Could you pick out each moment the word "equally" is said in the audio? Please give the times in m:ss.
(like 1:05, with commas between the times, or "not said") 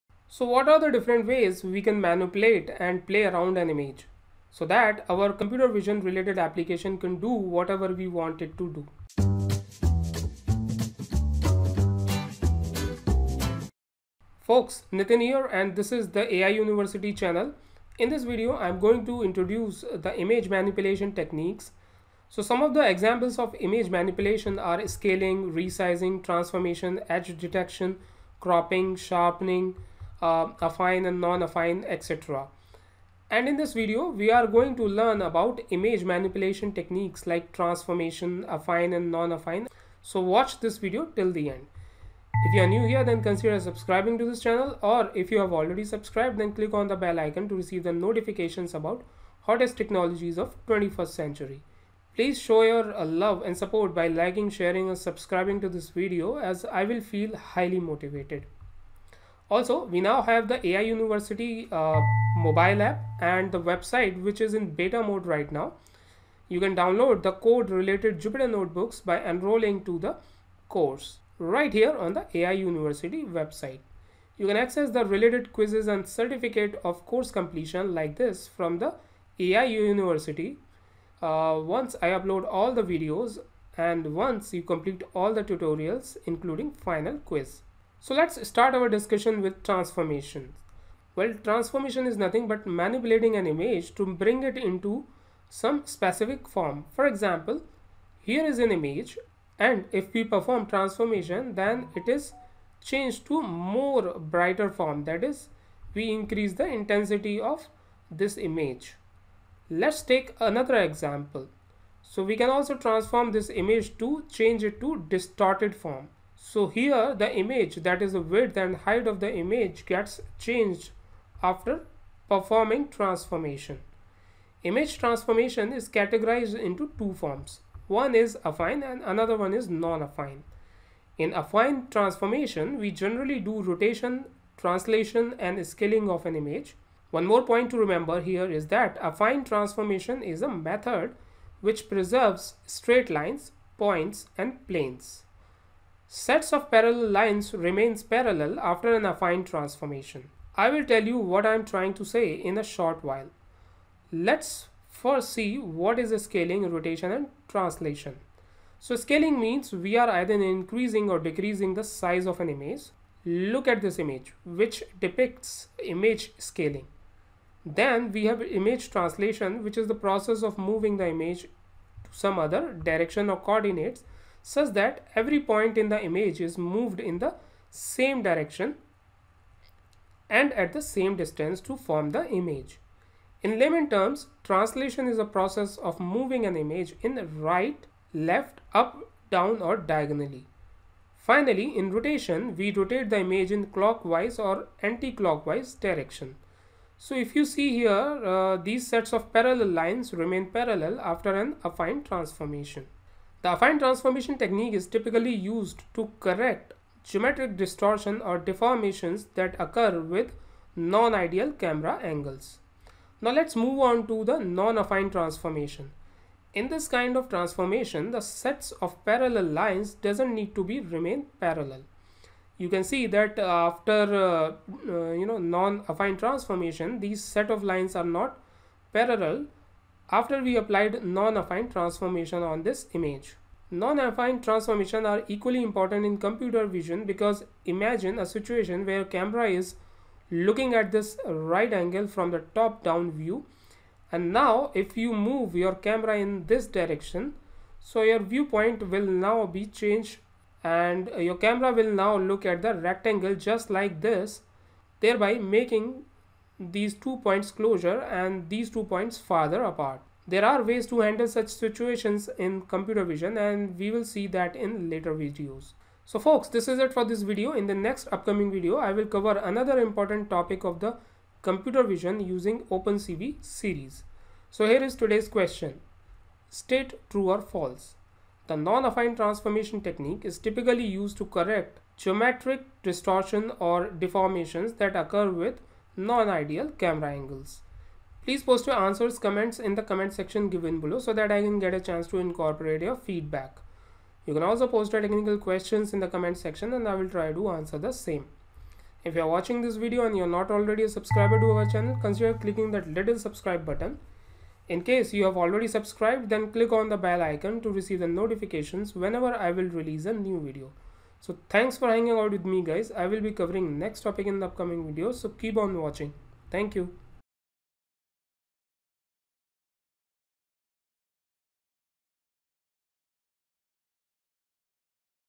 3:55.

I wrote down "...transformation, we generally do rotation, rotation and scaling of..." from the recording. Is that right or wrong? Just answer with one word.
wrong.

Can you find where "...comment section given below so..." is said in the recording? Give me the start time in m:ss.
4:49.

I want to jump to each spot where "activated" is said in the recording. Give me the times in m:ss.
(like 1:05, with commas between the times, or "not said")
not said.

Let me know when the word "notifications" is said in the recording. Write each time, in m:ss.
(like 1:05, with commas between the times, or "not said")
0:47, 5:08.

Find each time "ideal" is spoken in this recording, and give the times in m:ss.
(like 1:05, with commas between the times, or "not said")
3:30, 4:46.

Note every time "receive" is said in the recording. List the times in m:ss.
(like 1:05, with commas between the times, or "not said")
0:47, 5:07.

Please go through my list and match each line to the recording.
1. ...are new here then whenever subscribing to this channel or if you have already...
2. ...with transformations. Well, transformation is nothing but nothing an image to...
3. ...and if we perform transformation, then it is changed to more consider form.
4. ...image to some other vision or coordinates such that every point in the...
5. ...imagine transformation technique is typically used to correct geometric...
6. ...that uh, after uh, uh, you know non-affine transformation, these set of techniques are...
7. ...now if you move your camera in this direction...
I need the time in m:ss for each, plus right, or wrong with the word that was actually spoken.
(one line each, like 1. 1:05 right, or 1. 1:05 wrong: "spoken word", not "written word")
1. 0:42 wrong: "consider", not "whenever"
2. 1:29 wrong: "manipulating", not "nothing"
3. 1:39 wrong: "brighter", not "consider"
4. 2:51 wrong: "direction", not "vision"
5. 3:23 wrong: "affine", not "imagine"
6. 3:43 wrong: "lines", not "techniques"
7. 4:04 right.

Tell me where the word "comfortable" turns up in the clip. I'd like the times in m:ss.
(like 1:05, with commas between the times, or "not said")
not said.